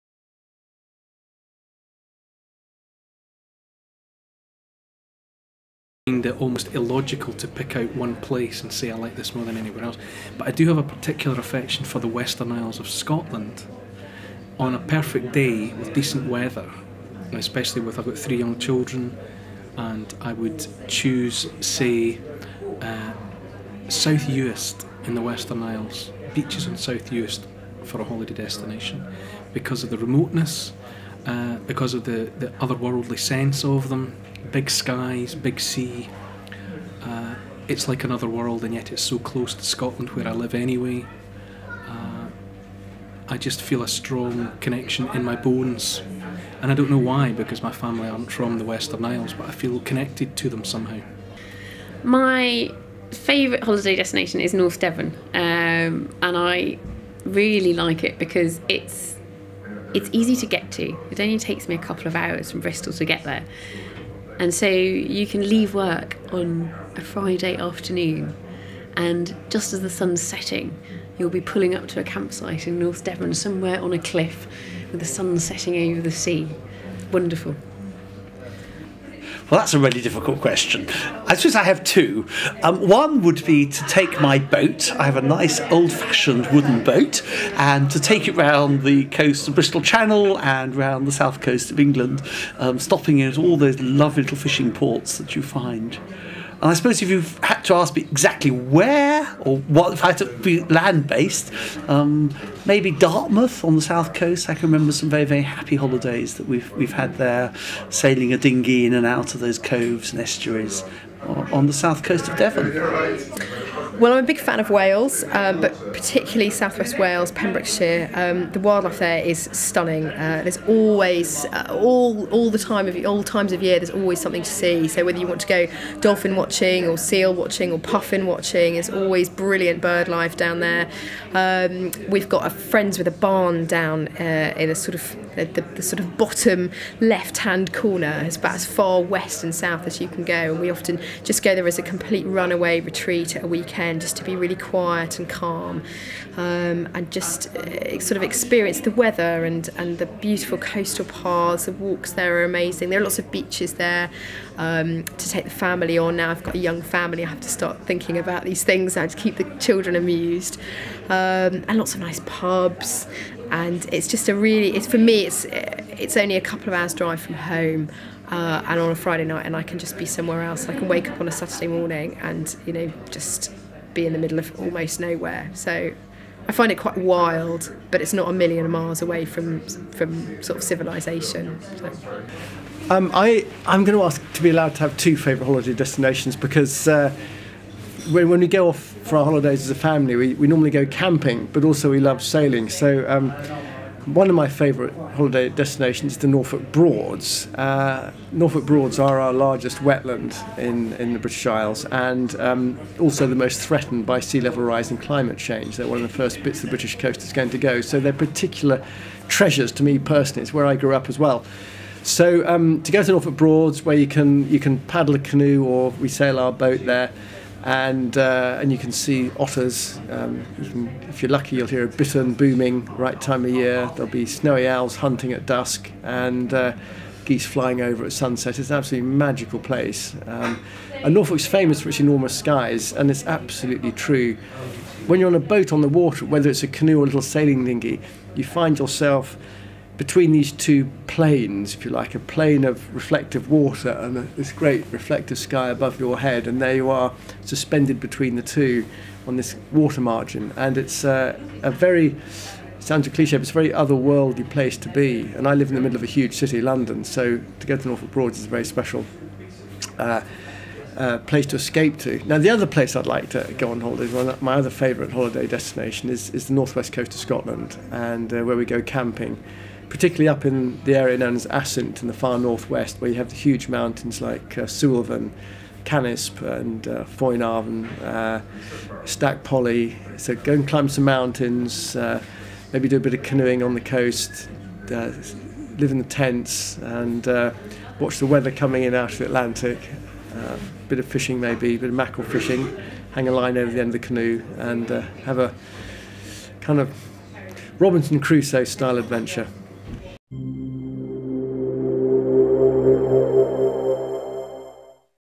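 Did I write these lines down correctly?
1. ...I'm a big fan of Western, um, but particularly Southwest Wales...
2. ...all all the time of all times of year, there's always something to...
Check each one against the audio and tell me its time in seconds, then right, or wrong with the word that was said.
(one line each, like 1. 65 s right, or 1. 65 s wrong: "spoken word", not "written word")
1. 114 s wrong: "Wales", not "Western"
2. 121 s right.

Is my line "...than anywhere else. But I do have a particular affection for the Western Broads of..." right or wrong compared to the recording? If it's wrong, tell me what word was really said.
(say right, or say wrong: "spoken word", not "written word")
wrong: "Isles", not "Broads".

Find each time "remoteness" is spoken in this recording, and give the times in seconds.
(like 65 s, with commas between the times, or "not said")
29 s.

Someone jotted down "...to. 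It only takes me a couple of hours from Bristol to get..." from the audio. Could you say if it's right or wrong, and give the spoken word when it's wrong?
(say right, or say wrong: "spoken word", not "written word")
right.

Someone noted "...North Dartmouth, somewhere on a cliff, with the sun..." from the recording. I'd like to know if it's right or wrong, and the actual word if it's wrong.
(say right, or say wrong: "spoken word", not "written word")
wrong: "Devon", not "Dartmouth".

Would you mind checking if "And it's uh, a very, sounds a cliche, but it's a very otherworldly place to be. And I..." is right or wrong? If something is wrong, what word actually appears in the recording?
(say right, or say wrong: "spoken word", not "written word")
right.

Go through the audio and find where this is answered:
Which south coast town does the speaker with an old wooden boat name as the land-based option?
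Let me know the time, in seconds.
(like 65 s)
102 s.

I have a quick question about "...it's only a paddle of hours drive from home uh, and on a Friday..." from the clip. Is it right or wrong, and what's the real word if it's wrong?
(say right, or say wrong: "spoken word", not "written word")
wrong: "couple", not "paddle".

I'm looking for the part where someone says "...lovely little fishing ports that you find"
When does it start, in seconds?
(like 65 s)
93 s.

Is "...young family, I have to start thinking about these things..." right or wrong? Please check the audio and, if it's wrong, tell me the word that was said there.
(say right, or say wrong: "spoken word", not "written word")
right.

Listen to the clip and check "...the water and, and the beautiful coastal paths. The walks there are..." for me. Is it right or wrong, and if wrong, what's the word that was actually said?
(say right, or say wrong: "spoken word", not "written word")
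wrong: "weather", not "water".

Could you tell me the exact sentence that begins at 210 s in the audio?
It's where I grew up as well.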